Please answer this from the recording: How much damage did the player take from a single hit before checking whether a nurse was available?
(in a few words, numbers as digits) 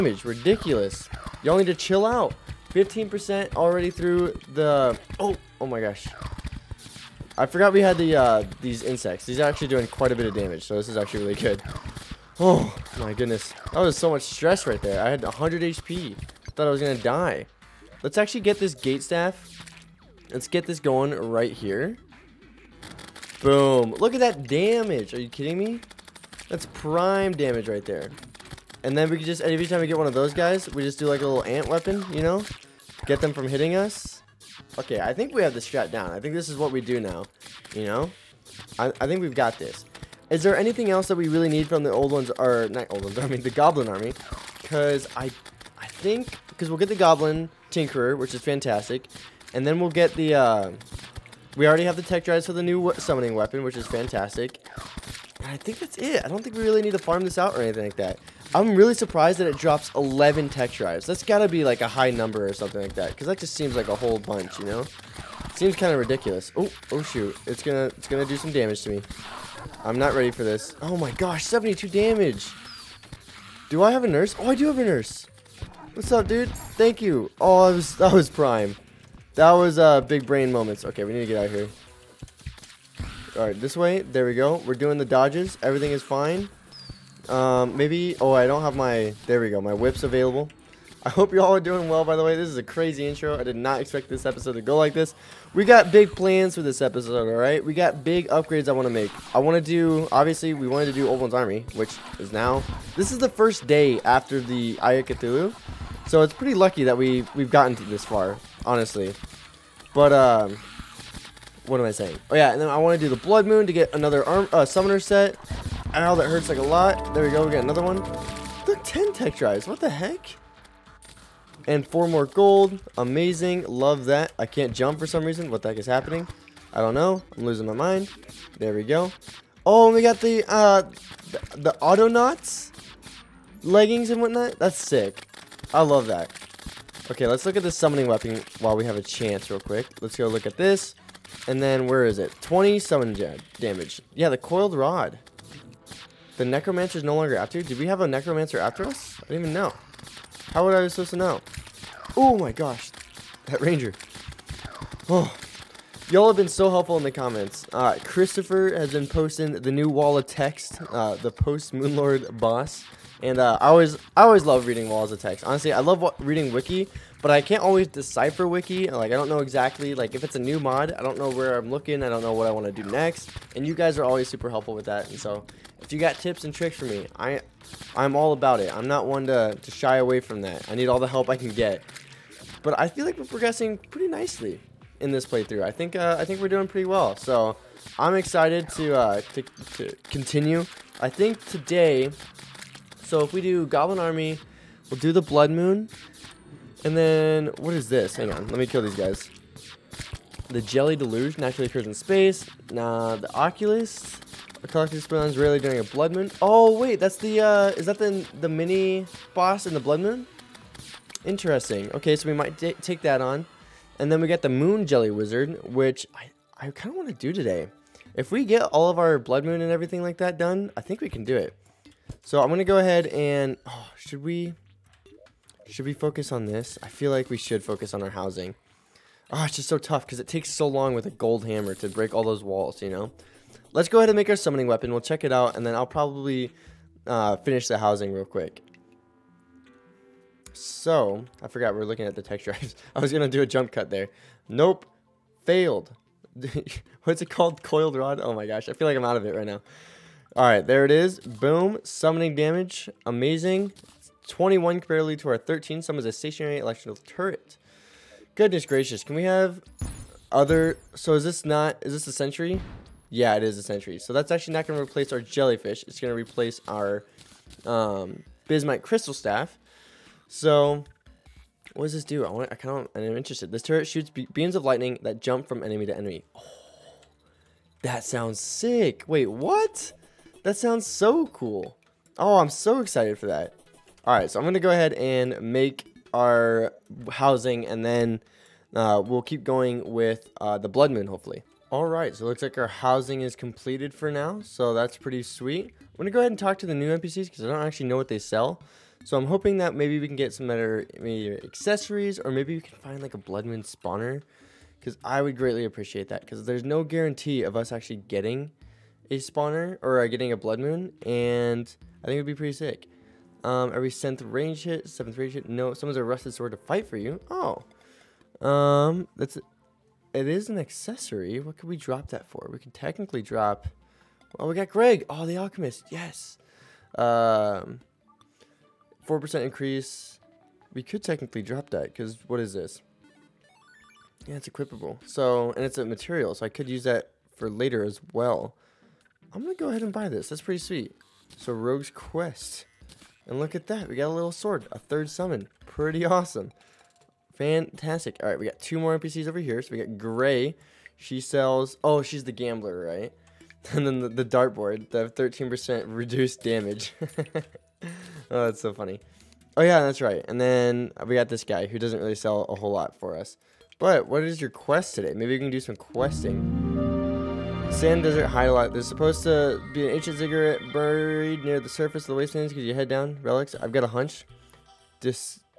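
72.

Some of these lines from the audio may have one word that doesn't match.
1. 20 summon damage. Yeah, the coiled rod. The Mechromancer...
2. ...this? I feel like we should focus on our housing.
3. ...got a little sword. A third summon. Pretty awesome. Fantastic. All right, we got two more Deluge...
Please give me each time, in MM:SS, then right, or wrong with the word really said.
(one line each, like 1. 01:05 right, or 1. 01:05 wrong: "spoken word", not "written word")
1. 02:22 right
2. 03:46 right
3. 05:43 wrong: "NPCs", not "Deluge".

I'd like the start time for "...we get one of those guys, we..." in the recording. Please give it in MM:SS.
00:29.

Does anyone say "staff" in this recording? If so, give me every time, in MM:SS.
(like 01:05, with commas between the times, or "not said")
00:19, 04:29.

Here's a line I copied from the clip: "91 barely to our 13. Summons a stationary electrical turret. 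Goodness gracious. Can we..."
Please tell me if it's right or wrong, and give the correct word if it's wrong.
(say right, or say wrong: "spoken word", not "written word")
wrong: "21", not "91".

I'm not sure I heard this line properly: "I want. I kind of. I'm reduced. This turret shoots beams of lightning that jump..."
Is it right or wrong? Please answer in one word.
wrong.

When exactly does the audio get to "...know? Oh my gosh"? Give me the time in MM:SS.
02:31.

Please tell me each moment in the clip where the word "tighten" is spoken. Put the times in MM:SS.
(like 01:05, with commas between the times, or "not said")
not said.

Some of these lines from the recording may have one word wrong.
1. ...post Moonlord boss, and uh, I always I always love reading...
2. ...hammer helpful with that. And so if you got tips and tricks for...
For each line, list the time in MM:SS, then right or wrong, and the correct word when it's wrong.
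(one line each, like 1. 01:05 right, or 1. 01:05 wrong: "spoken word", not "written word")
1. 02:41 right
2. 02:54 wrong: "super", not "hammer".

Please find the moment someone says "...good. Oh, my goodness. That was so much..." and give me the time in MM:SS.
00:11.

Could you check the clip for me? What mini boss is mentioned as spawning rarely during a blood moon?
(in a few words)
The Oculus.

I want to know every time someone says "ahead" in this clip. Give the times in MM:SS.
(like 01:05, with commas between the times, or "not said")
03:42, 03:53, 04:44, 04:56, 05:39.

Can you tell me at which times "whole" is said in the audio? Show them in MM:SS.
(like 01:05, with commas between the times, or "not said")
01:03, 06:02.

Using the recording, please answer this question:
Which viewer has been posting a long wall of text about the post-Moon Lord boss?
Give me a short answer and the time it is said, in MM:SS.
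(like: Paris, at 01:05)
Christopher, at 02:38.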